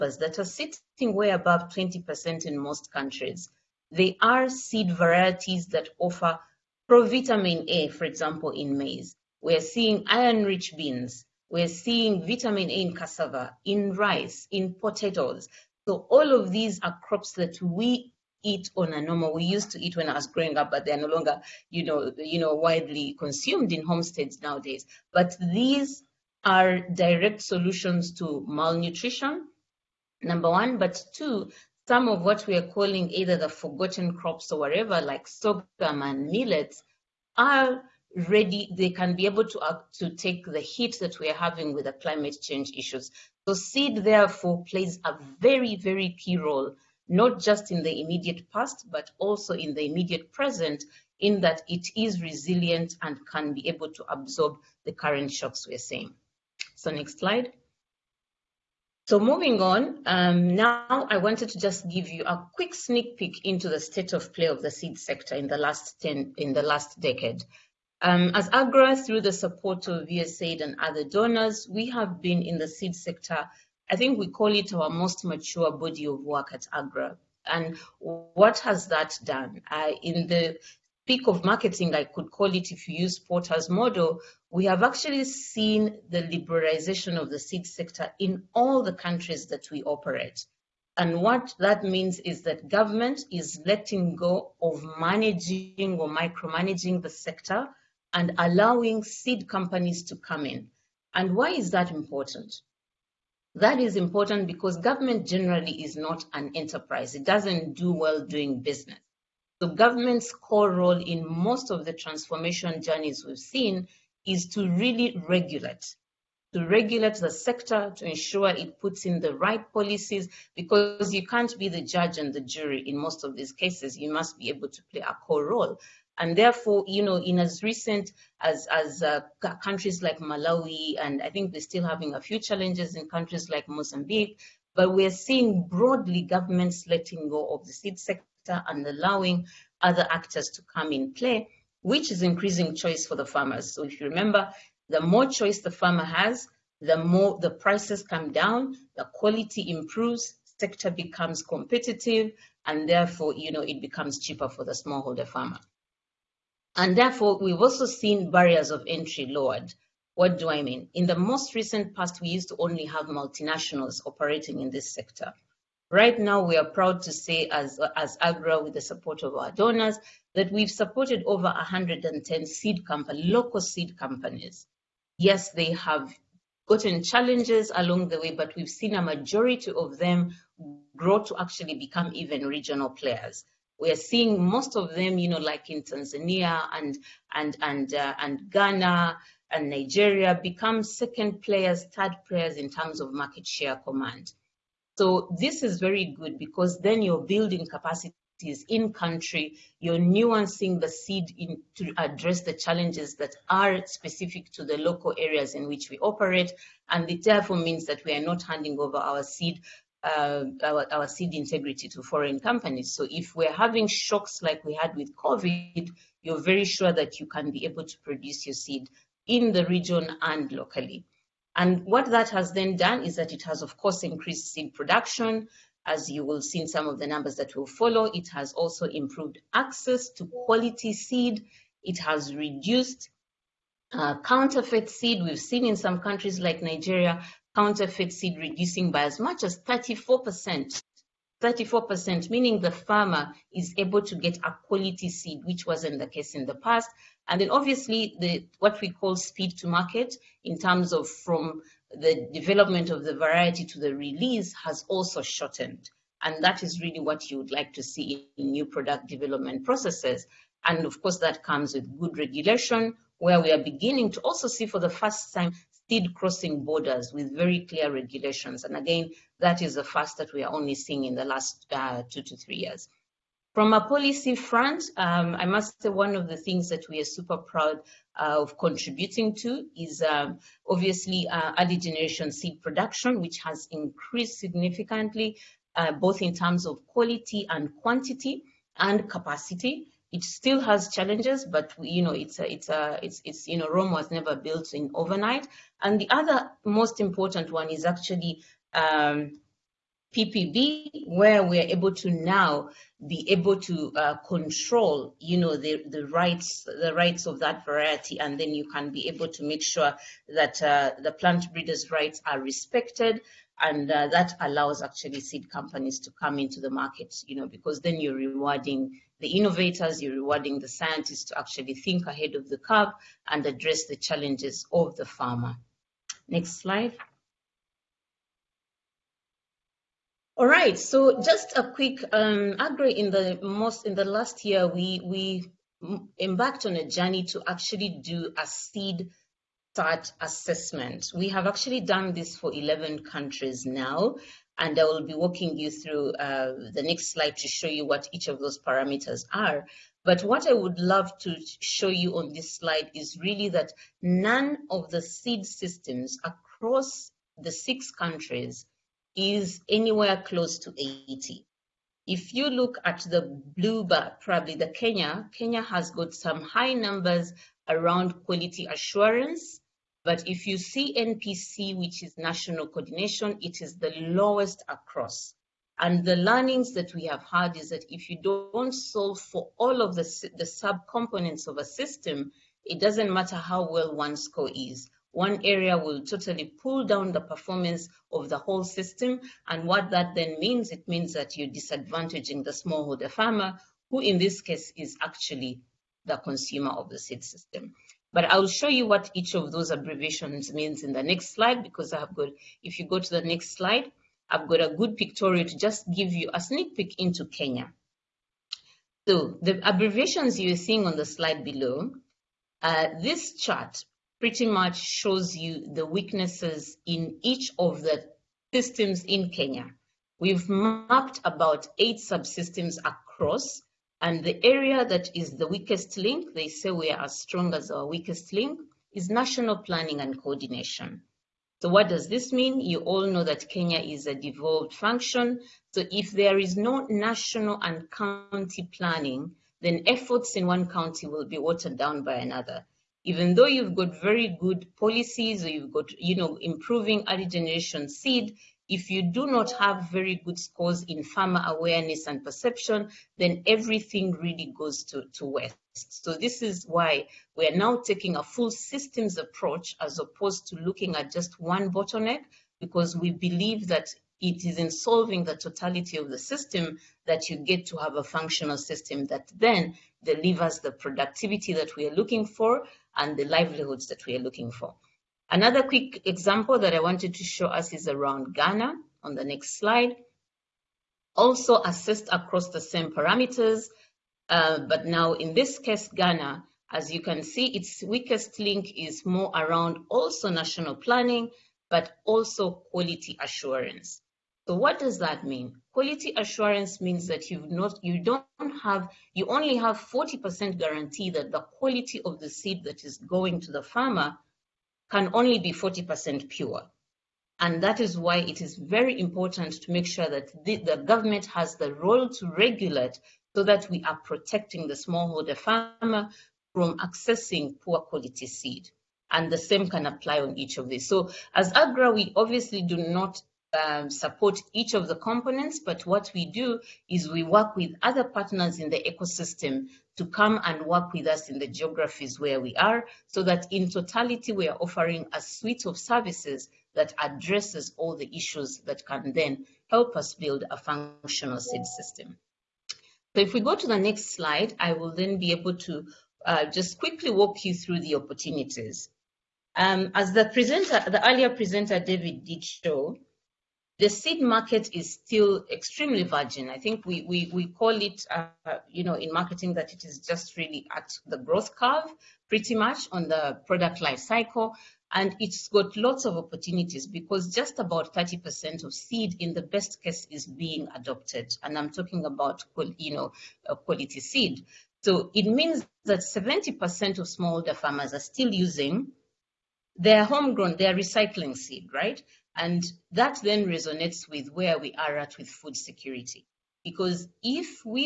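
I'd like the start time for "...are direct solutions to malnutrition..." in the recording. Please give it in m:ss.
0:26.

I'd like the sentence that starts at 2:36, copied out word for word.
And therefore, we've also seen barriers of entry lowered.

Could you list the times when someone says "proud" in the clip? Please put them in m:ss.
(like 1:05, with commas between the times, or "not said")
2:46, 4:37.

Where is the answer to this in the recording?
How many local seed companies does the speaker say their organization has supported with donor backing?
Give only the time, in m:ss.
2:51.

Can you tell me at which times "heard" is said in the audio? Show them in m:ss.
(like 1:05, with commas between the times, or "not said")
not said.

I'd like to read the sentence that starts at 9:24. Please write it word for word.
And it's got lots of opportunities because just about 30% of seed in the best case is being adopted.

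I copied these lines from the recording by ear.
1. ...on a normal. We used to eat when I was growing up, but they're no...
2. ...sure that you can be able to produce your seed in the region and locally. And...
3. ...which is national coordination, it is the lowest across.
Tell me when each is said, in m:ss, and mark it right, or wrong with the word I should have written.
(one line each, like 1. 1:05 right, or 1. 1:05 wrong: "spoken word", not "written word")
1. 0:18 right
2. 3:36 right
3. 6:11 right.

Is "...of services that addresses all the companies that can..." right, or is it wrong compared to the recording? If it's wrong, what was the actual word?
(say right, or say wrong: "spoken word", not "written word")
wrong: "issues", not "companies".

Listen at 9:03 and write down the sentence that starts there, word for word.
So if we go to the next slide, I will then be able to uh, just quickly walk you through the opportunities.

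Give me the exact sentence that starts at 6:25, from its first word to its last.
One area will totally pull down the performance of the whole system.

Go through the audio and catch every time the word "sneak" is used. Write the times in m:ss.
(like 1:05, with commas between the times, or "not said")
1:02, 6:46.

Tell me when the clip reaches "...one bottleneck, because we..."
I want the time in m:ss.
7:41.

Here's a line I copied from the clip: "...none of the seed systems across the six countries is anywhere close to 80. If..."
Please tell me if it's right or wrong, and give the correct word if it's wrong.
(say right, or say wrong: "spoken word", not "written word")
right.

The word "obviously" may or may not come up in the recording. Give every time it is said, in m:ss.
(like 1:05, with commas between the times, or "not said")
4:07, 4:40, 8:42.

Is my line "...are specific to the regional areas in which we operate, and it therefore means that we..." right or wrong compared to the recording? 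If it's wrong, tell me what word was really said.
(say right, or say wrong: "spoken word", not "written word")
wrong: "local", not "regional".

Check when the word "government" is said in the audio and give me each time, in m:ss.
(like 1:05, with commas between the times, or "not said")
1:32, 1:44, 1:49, 2:16, 8:30.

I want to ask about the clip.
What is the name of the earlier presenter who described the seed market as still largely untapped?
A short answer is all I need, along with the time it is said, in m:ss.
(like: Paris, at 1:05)
David, at 9:11.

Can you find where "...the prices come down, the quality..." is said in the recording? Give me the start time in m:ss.
2:27.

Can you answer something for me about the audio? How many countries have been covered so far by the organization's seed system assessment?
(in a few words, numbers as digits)
11.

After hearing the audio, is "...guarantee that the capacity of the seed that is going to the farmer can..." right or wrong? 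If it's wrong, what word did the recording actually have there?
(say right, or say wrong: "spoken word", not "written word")
wrong: "quality", not "capacity".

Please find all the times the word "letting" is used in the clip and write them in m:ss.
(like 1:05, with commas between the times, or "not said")
1:33, 2:16.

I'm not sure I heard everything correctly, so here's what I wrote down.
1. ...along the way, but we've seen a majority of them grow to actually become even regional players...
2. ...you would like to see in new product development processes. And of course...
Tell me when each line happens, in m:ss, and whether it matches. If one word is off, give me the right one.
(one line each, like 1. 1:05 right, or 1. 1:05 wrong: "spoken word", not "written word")
1. 2:57 right
2. 4:17 right.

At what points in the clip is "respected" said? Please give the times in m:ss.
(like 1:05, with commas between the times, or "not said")
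5:12.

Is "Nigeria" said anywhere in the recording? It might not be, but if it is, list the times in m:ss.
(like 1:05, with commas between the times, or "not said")
3:09, 3:56.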